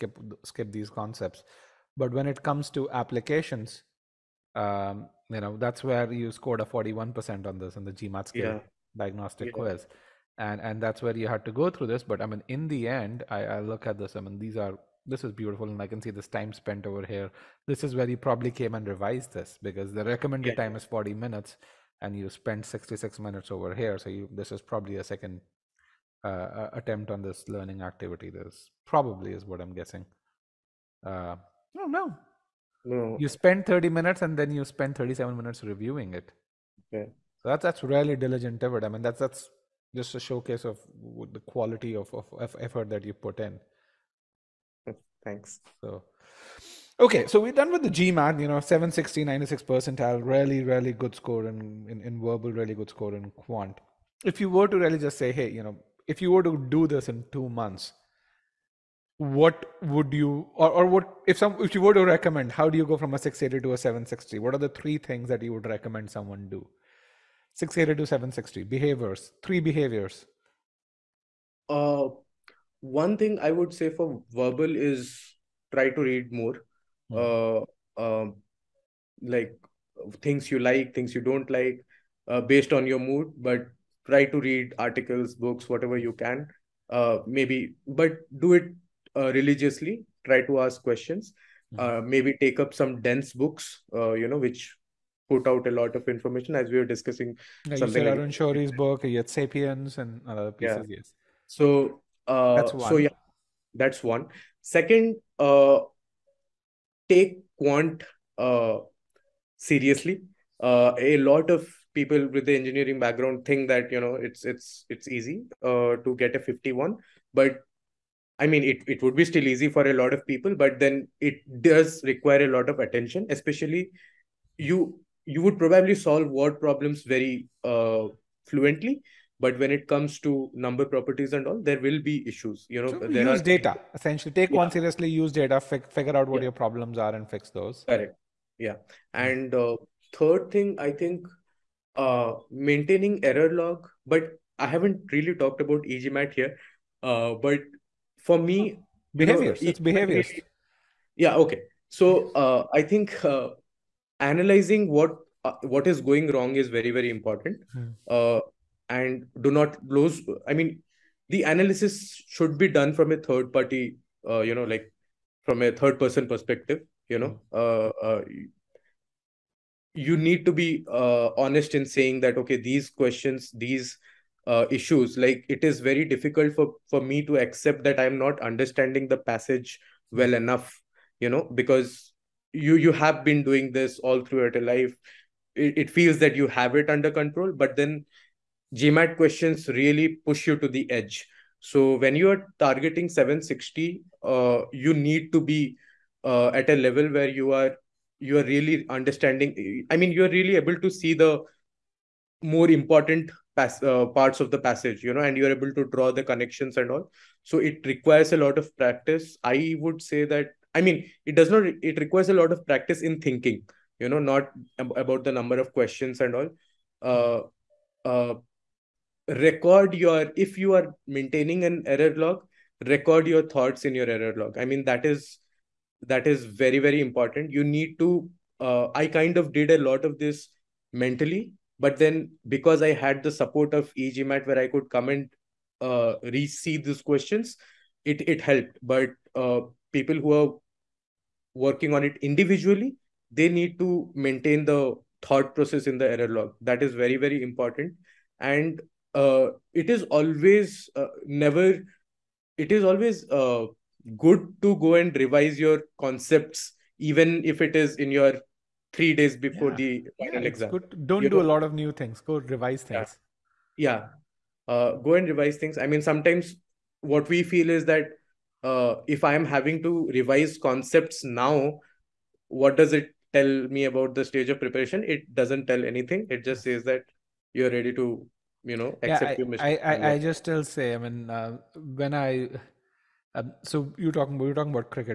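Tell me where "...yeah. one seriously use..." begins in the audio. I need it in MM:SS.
02:14.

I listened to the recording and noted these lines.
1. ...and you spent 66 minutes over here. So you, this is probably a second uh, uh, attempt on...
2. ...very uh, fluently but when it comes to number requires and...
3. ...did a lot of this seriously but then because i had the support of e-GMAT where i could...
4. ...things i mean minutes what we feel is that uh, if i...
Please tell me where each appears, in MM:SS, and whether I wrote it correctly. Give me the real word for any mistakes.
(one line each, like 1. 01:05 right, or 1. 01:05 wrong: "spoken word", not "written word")
1. 00:22 right
2. 02:07 wrong: "properties", not "requires"
3. 03:49 wrong: "mentally", not "seriously"
4. 04:25 wrong: "sometimes", not "minutes".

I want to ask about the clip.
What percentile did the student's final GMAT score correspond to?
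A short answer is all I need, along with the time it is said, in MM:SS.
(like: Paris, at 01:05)
96 percentile, at 00:49.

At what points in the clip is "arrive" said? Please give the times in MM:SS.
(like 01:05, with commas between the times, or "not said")
not said.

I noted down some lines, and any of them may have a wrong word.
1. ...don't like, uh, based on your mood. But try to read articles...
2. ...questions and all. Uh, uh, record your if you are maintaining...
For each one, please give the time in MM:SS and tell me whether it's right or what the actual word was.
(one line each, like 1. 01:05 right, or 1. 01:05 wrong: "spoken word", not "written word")
1. 01:21 right
2. 03:35 right.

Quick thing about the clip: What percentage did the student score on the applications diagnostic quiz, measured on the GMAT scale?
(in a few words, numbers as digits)
41%.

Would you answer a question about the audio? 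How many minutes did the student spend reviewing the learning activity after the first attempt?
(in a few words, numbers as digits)
37 minutes.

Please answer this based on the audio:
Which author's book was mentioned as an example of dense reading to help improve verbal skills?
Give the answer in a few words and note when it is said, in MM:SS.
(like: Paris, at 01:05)
Arun Shourie, at 01:38.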